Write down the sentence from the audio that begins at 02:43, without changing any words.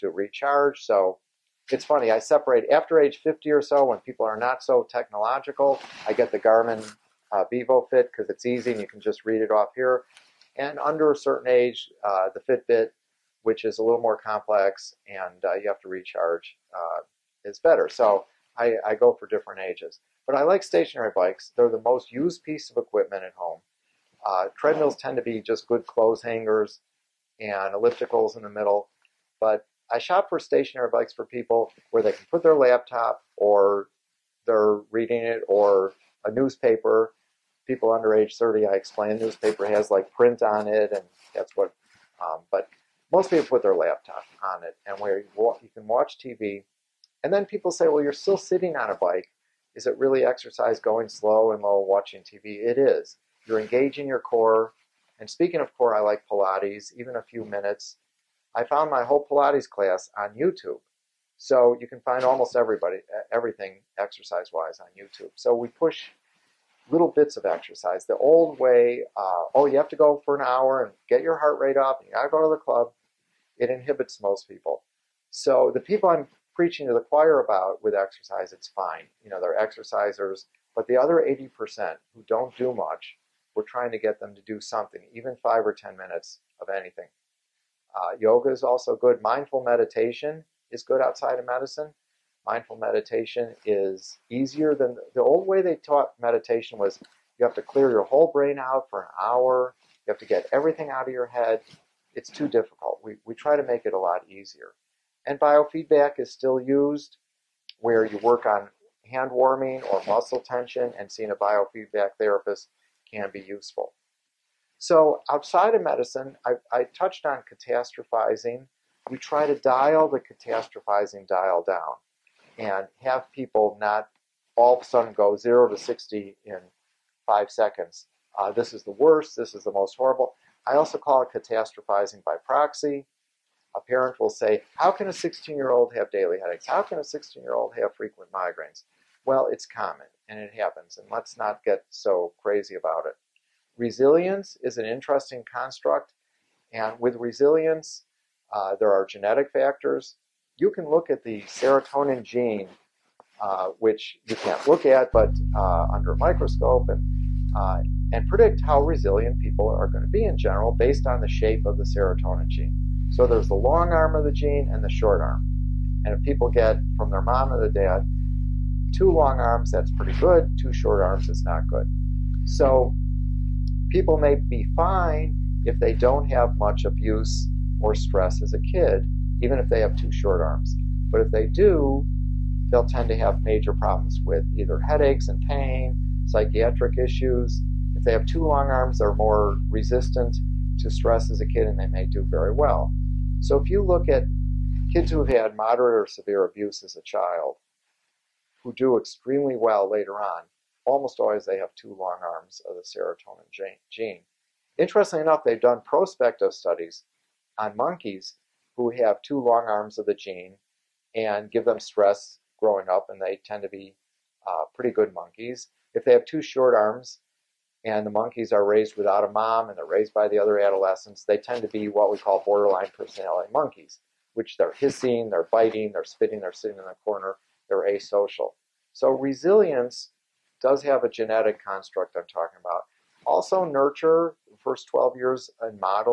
So there's the long arm of the gene and the short arm.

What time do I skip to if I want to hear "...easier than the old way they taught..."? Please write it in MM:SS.
01:34.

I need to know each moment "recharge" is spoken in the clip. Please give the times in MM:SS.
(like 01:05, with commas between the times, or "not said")
00:00, 00:15.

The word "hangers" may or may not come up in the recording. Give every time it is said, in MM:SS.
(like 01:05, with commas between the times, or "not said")
00:26.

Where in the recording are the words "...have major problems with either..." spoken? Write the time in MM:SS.
03:03.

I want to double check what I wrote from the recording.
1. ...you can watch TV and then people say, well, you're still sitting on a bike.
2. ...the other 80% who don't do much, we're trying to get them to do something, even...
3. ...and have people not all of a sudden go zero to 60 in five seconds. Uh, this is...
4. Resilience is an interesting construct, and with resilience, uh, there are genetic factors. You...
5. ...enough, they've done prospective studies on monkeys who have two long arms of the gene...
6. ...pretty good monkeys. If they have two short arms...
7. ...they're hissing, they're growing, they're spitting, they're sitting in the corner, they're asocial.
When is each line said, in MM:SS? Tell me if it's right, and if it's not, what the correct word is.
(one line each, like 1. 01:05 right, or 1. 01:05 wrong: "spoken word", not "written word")
1. 00:45 right
2. 01:20 right
3. 02:02 right
4. 02:23 right
5. 03:25 right
6. 03:34 right
7. 03:44 wrong: "biting", not "growing".